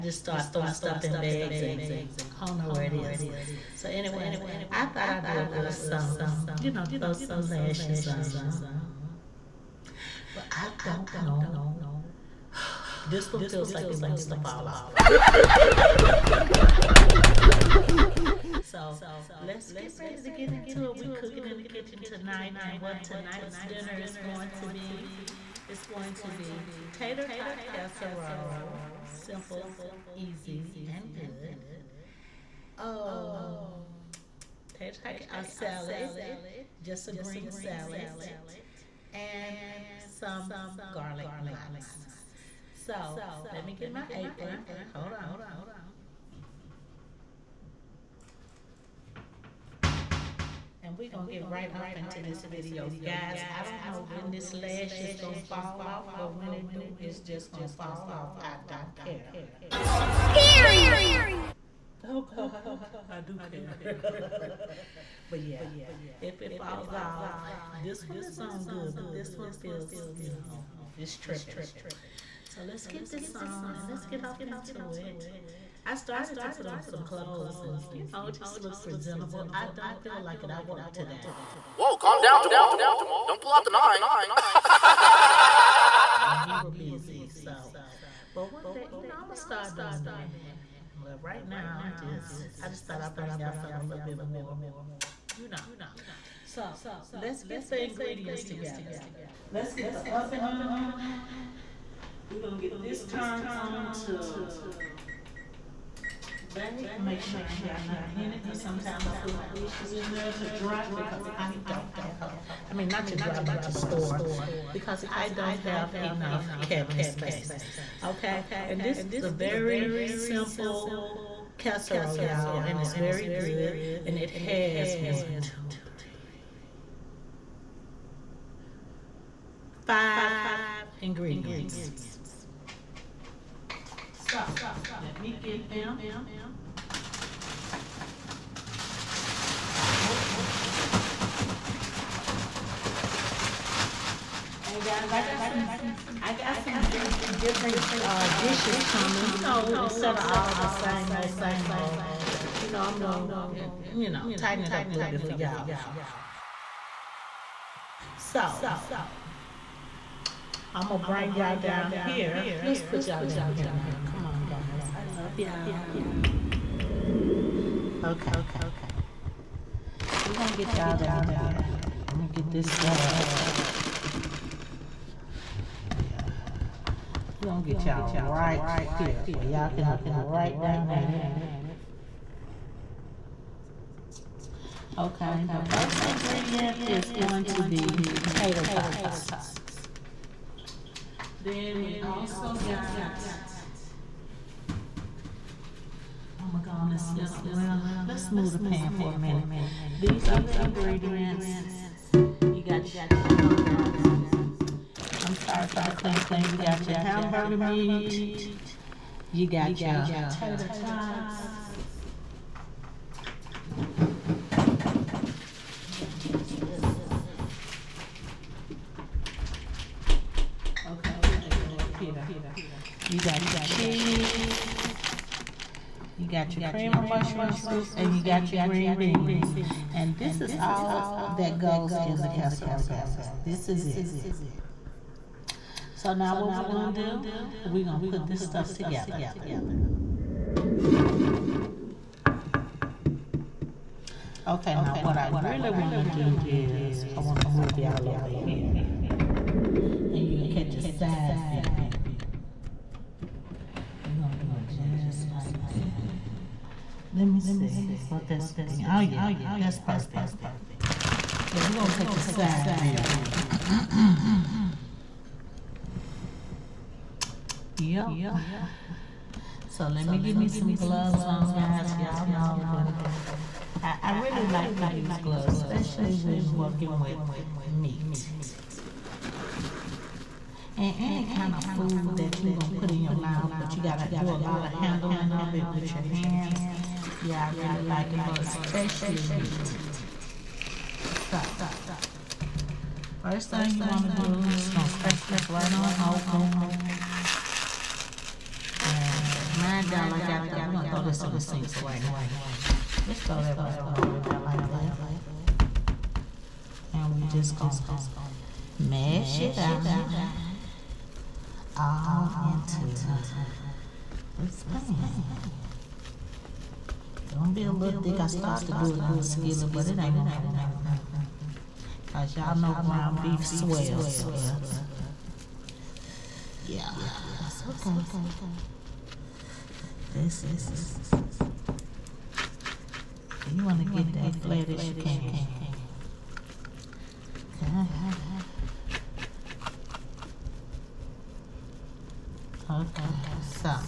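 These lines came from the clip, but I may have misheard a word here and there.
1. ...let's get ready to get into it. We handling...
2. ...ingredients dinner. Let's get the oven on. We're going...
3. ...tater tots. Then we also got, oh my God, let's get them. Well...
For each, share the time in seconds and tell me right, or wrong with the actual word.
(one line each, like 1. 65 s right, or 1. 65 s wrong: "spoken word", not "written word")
1. 19 s wrong: "cooking", not "handling"
2. 97 s wrong: "together", not "dinner"
3. 187 s right.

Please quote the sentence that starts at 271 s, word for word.
Y'all know when I, I really like to use gloves, especially when working with meat.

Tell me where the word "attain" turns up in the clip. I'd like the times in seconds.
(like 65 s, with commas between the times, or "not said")
not said.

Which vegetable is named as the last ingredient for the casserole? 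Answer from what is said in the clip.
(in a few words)
Green beans.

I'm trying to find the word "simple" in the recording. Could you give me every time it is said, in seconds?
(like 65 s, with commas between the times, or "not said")
29 s, 120 s.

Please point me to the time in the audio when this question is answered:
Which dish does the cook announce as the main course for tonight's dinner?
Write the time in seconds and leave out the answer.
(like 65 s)
26 s.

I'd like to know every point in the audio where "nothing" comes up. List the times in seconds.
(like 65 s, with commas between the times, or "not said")
107 s, 320 s.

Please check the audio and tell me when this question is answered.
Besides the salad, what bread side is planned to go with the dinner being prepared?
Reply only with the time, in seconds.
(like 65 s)
40 s.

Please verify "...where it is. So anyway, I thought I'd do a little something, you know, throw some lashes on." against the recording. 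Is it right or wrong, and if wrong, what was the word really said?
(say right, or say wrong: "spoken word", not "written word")
right.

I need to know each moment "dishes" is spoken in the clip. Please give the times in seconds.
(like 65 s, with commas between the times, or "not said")
109 s, 148 s.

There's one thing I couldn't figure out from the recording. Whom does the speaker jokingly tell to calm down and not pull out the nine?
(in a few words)
Jamal.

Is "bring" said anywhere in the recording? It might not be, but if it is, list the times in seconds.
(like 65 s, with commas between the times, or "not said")
93 s, 161 s.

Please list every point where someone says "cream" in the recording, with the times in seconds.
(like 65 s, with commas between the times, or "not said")
226 s.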